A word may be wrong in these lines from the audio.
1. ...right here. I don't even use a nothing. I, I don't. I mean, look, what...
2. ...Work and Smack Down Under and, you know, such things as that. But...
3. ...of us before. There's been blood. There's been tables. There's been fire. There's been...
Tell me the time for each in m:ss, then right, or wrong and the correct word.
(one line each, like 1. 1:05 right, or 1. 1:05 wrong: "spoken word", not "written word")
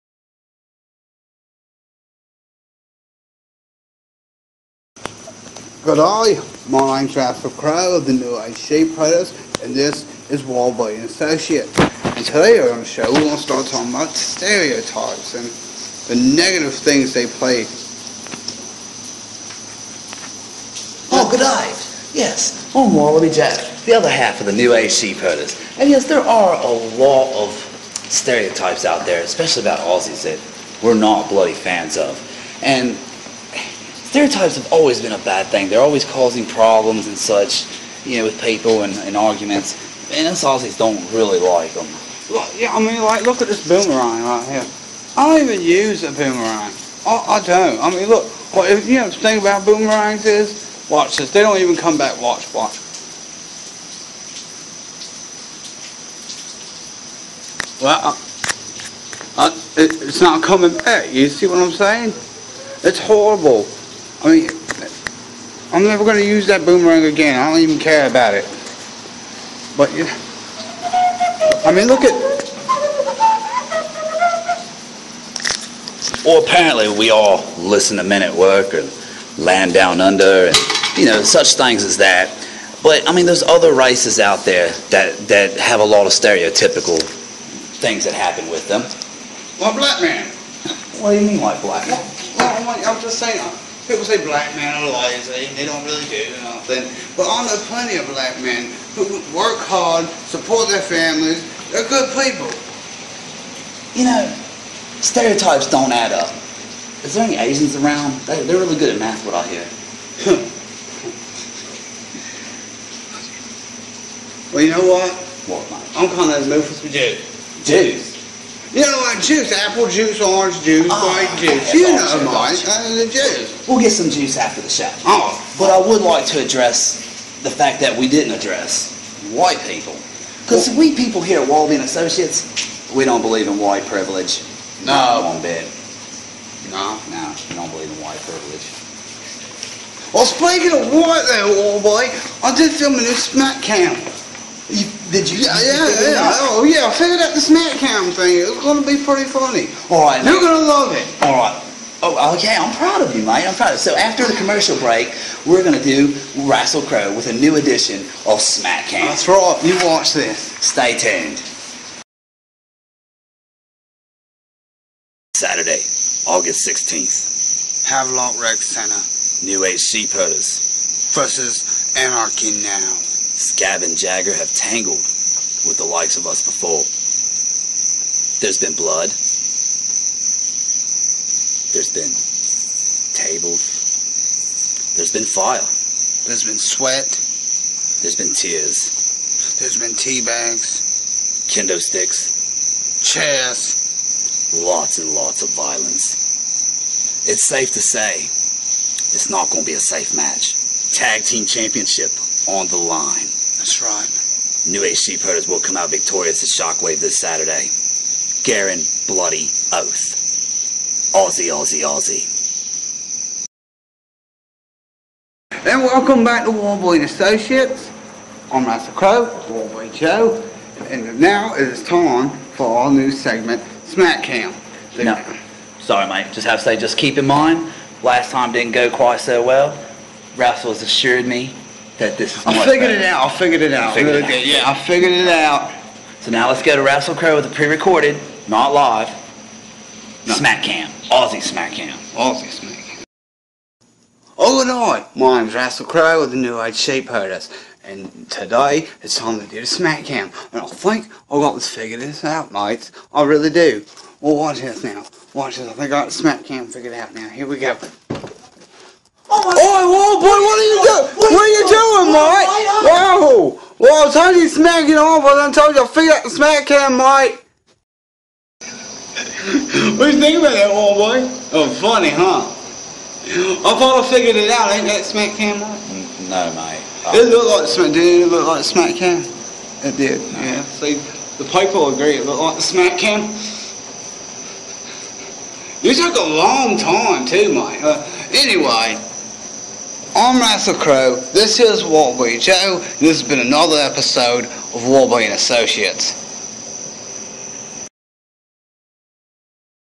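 1. 0:44 wrong: "boomerang", not "nothing"
2. 1:18 wrong: "Land", not "Smack"
3. 2:56 right.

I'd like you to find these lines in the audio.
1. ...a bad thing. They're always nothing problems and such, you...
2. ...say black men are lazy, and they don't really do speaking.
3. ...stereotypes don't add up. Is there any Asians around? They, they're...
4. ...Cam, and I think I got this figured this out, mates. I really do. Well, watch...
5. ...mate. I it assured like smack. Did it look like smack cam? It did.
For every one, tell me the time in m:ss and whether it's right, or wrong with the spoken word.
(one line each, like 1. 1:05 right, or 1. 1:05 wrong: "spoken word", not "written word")
1. 0:35 wrong: "causing", not "nothing"
2. 1:34 wrong: "nothing", not "speaking"
3. 1:45 right
4. 4:10 right
5. 4:36 wrong: "looked", not "assured".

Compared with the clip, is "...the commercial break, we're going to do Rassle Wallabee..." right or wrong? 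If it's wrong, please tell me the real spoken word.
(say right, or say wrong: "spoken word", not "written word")
wrong: "Crowe", not "Wallabee".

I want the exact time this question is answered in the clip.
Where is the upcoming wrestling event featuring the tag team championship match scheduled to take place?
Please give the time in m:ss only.
2:47.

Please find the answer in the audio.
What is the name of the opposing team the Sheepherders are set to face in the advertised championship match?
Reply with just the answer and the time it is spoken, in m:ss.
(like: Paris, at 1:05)
Anarchy Now, at 2:51.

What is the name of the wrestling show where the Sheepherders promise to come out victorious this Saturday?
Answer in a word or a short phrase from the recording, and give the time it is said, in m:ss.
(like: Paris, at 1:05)
Shockwave, at 3:26.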